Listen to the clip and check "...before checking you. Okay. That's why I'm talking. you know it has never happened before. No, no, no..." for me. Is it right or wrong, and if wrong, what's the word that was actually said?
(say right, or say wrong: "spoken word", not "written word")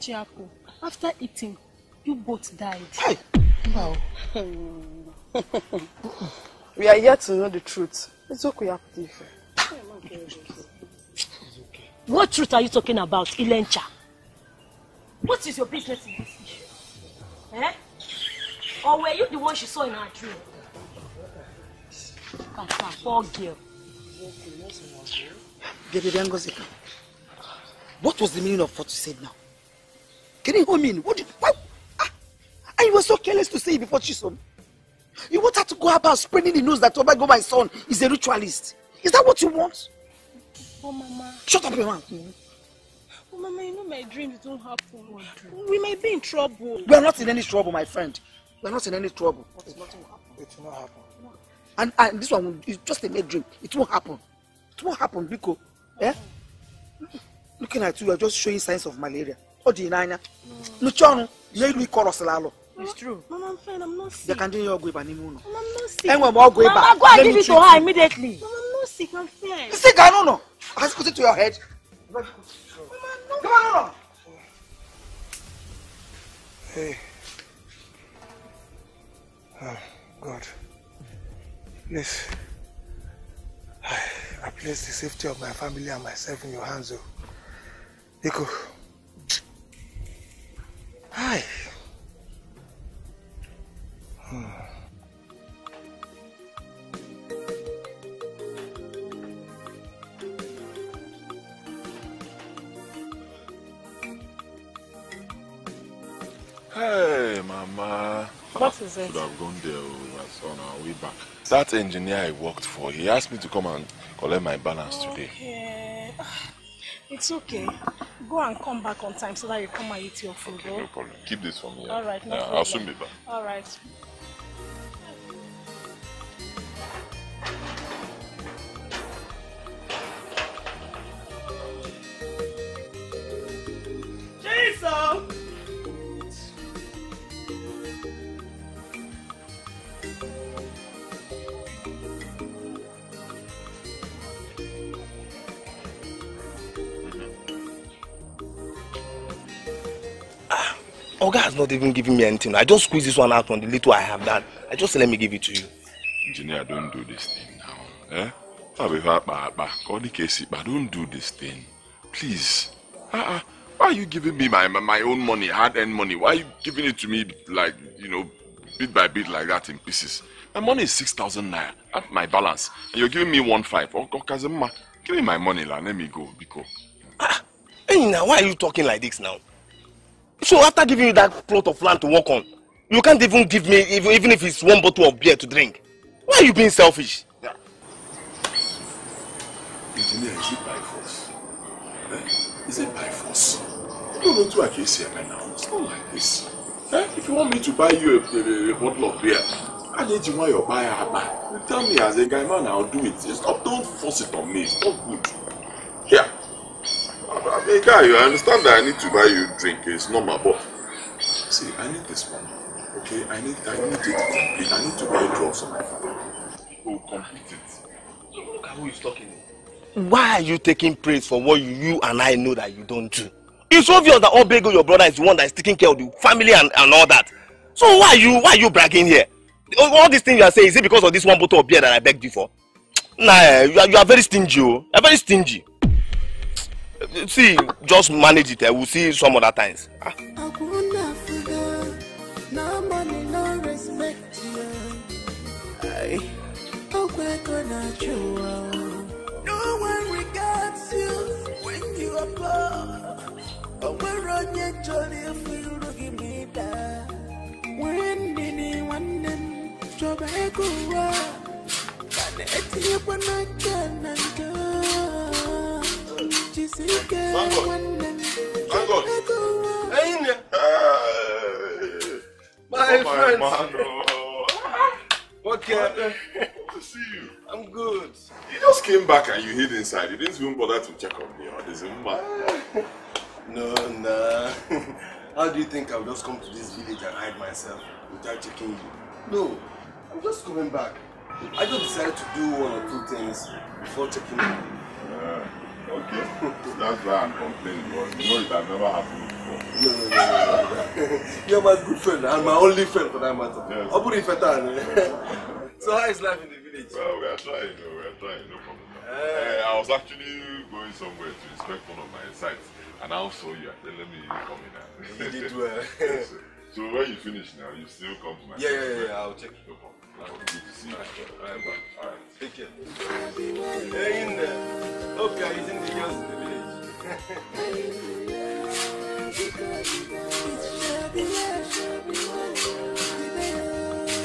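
wrong: "complaining", not "talking".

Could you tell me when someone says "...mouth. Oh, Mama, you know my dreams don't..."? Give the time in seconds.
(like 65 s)
41 s.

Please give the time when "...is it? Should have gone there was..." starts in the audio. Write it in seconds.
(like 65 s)
108 s.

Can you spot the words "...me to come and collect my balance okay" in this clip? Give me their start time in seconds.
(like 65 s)
113 s.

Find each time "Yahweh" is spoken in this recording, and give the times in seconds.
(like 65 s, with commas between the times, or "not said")
not said.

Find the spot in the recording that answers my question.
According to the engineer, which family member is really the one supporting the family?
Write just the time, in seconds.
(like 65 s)
224 s.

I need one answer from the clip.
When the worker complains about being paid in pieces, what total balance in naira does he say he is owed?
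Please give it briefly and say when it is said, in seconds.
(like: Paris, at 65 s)
6,000 naira, at 170 s.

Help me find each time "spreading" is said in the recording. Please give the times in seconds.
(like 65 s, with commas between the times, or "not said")
36 s.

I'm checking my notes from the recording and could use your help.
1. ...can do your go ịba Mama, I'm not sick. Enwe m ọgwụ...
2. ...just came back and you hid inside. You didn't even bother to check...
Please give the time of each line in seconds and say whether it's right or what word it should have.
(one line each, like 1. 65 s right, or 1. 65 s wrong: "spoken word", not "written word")
1. 64 s right
2. 278 s right.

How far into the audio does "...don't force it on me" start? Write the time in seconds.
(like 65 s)
203 s.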